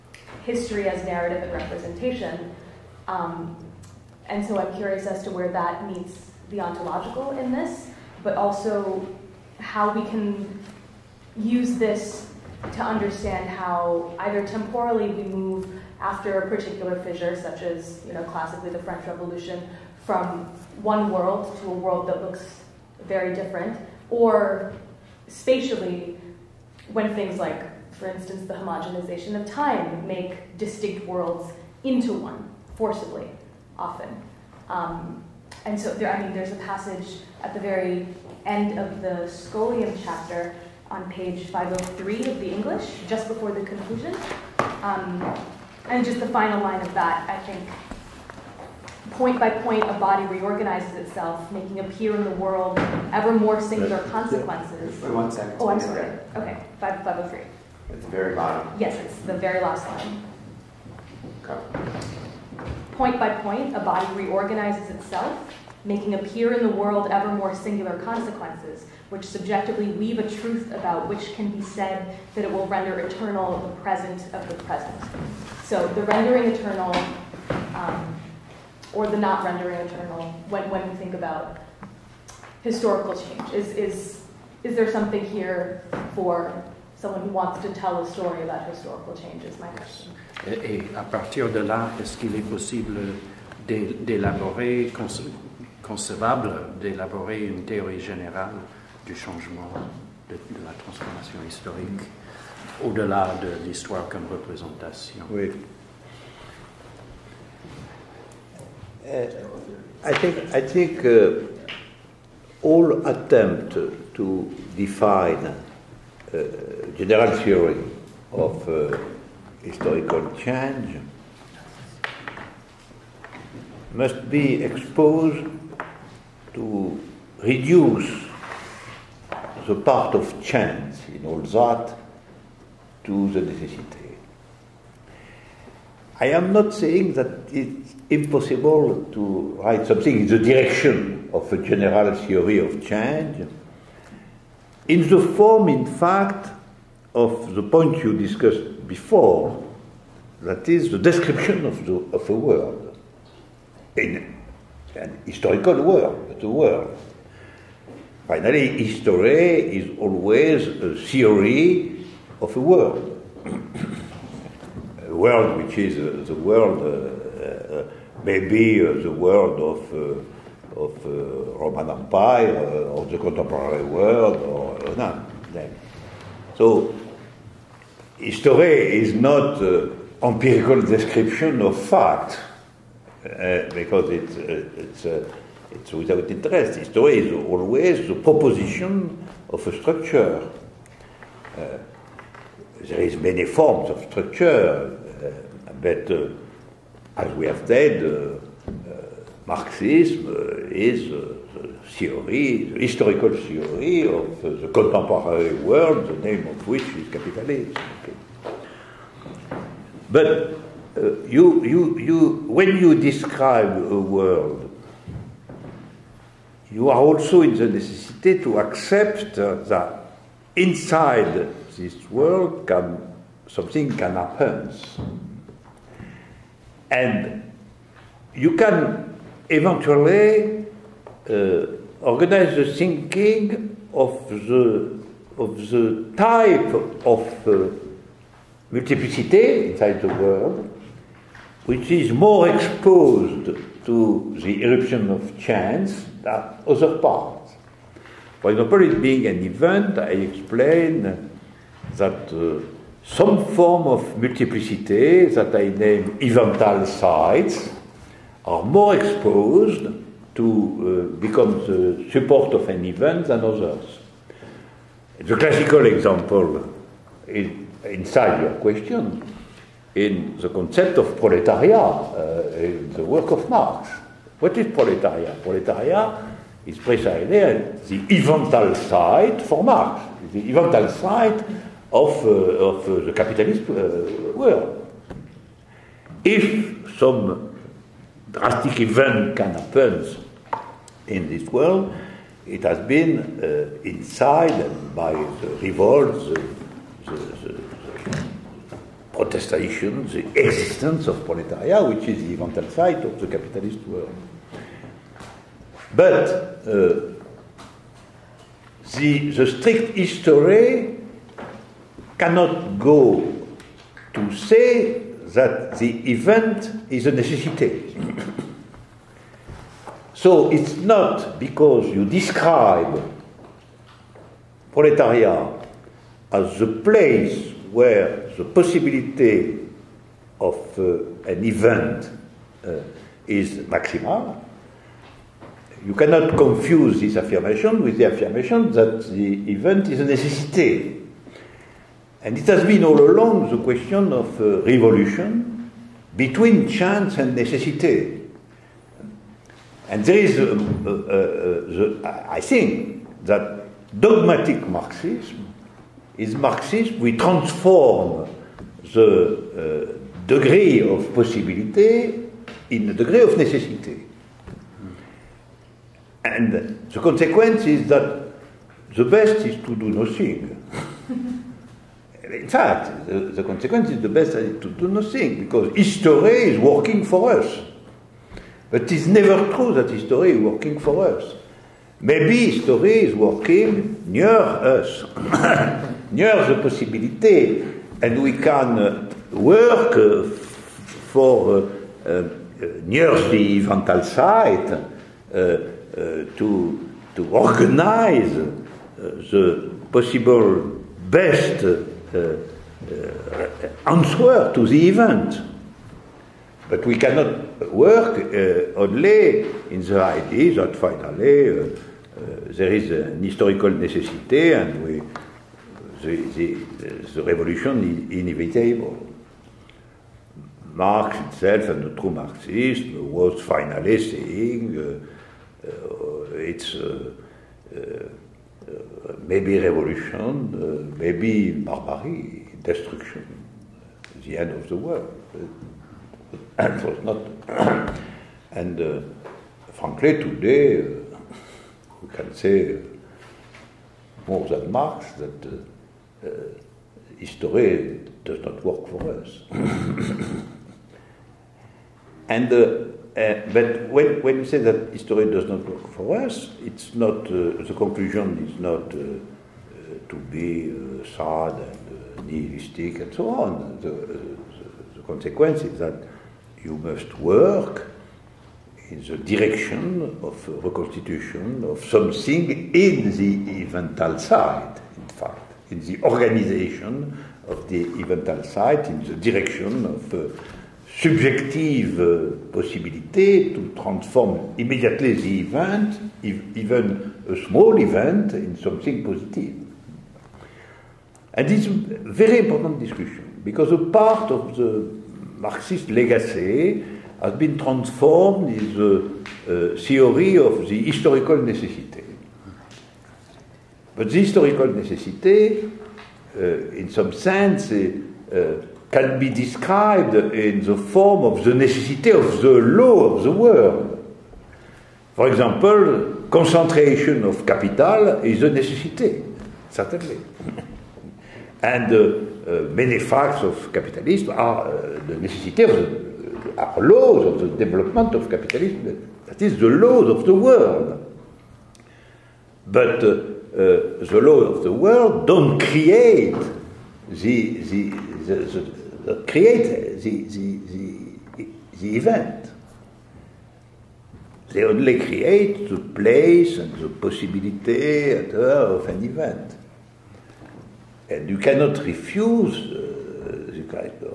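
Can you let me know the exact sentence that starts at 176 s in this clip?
So, history is not empirical description of fact because it's, it's So without interest, History is always, the proposition of a structure.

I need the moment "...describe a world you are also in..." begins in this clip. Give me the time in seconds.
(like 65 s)
212 s.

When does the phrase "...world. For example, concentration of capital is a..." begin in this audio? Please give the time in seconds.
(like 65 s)
513 s.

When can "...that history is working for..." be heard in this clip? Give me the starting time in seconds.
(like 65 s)
379 s.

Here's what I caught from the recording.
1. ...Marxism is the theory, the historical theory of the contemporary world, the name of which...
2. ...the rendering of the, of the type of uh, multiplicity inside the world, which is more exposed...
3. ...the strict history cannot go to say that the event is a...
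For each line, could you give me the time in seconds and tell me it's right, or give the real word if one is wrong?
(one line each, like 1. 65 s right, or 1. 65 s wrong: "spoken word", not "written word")
1. 199 s right
2. 232 s wrong: "thinking", not "rendering"
3. 309 s right.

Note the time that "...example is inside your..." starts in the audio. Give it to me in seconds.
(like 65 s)
265 s.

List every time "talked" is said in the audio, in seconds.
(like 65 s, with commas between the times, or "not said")
not said.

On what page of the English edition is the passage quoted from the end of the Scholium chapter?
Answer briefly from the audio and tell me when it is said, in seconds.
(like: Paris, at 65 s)
503, at 41 s.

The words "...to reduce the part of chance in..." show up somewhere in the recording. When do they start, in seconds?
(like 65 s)
126 s.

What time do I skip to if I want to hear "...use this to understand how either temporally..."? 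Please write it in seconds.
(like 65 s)
11 s.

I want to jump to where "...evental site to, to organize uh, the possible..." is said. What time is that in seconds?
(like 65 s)
393 s.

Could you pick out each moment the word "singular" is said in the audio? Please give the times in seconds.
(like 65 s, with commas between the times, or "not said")
53 s, 67 s.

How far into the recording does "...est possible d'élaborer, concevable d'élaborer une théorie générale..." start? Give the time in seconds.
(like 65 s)
92 s.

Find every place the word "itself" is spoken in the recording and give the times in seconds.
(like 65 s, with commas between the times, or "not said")
50 s, 64 s, 421 s.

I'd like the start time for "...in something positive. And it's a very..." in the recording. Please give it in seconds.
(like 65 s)
488 s.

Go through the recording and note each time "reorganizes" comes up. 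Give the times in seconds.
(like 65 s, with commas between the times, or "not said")
50 s, 64 s.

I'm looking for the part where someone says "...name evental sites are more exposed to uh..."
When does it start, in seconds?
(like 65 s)
255 s.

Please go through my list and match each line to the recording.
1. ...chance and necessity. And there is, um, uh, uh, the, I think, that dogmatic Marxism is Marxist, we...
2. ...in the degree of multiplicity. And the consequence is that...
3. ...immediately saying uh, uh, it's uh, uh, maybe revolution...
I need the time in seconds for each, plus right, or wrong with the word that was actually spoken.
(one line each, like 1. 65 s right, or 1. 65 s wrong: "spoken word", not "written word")
1. 346 s right
2. 362 s wrong: "necessity", not "multiplicity"
3. 423 s wrong: "finally", not "immediately".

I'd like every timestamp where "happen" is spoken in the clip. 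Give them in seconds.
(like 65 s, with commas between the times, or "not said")
224 s, 289 s.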